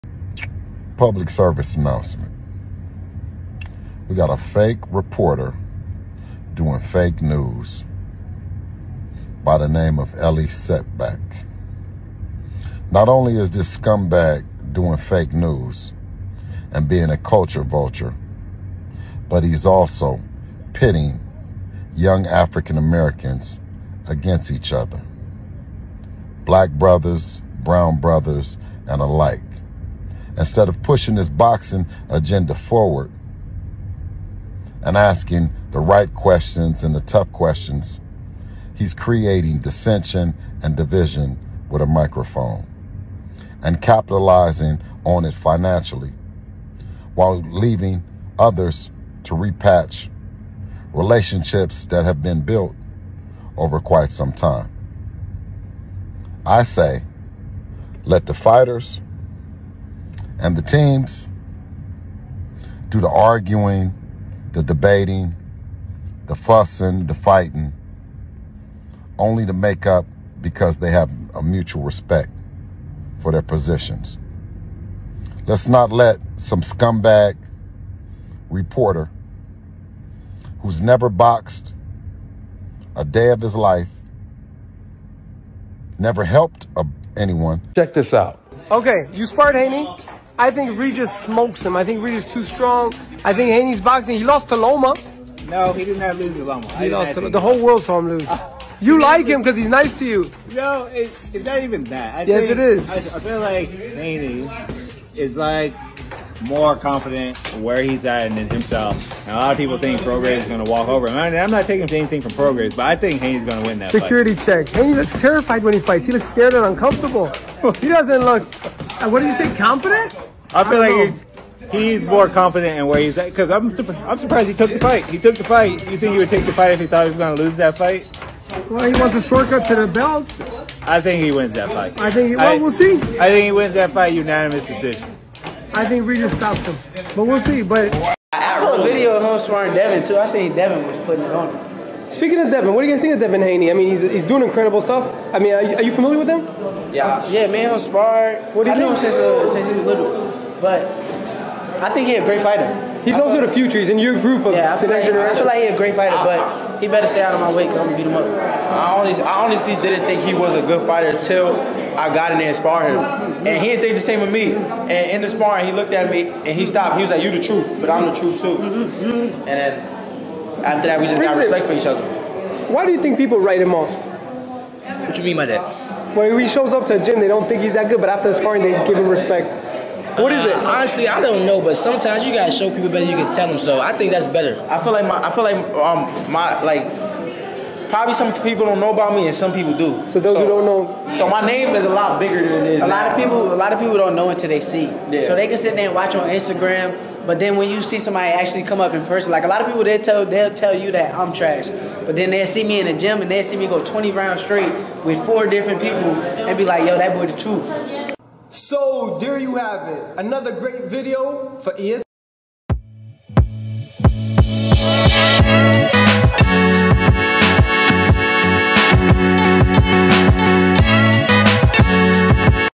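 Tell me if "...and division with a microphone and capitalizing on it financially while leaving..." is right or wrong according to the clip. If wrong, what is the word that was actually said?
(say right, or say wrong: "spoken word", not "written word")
right.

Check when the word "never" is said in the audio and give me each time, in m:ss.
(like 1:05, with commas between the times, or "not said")
1:20, 1:25.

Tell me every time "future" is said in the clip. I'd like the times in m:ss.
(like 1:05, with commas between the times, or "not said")
2:33.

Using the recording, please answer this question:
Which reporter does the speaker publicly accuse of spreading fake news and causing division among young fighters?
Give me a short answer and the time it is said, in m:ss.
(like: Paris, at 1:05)
Elie Seckbach, at 0:10.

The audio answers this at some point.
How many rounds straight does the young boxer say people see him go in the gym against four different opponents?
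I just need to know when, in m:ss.
3:23.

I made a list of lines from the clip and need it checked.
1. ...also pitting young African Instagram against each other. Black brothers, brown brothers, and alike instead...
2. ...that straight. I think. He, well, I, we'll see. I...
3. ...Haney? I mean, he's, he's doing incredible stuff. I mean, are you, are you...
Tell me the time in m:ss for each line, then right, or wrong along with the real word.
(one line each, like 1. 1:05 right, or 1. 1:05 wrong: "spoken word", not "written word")
1. 0:19 wrong: "Americans", not "Instagram"
2. 2:11 wrong: "fight", not "straight"
3. 2:23 right.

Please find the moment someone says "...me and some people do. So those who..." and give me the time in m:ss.
3:09.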